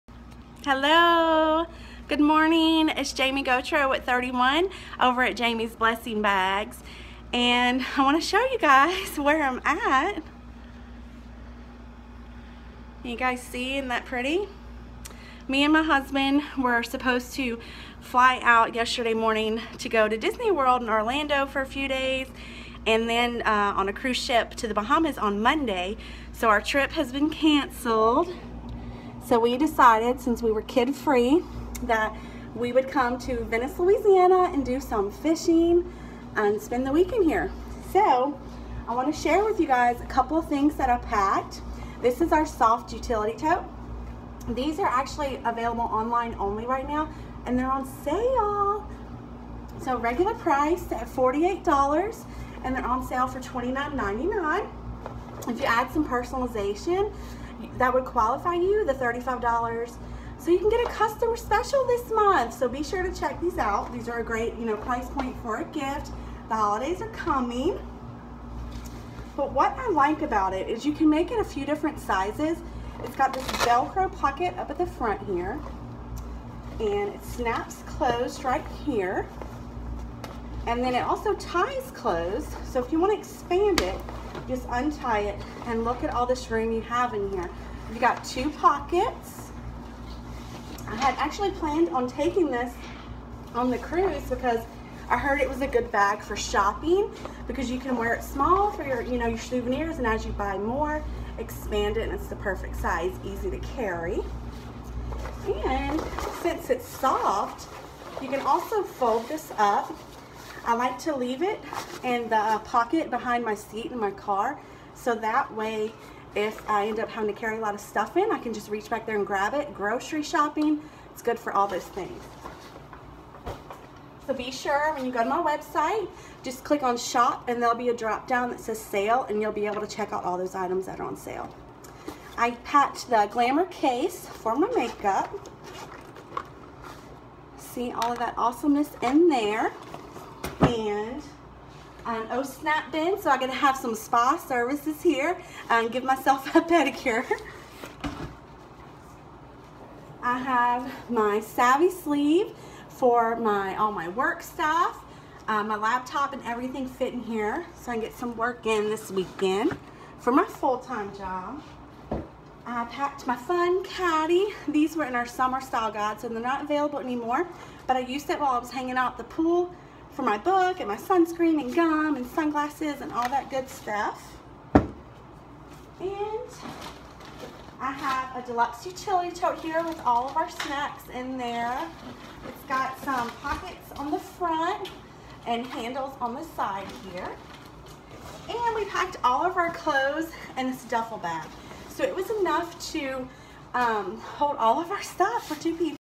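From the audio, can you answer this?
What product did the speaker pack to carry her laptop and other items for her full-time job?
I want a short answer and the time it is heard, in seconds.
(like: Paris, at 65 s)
savvy sleeve, at 151 s.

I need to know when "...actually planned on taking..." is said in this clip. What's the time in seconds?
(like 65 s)
91 s.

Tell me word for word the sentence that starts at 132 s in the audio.
I packed the Glamour case for my makeup.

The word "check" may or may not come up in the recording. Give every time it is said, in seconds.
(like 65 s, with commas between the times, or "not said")
63 s, 129 s.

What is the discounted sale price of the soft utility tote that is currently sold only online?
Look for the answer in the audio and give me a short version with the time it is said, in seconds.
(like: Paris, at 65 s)
$29.99, at 53 s.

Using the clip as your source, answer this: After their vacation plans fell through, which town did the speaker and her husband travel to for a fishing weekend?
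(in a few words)
Venice, Louisiana.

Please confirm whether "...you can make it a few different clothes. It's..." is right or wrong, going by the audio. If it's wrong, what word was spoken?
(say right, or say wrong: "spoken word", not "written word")
wrong: "sizes", not "clothes".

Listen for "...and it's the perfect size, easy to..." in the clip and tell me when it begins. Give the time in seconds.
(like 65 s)
102 s.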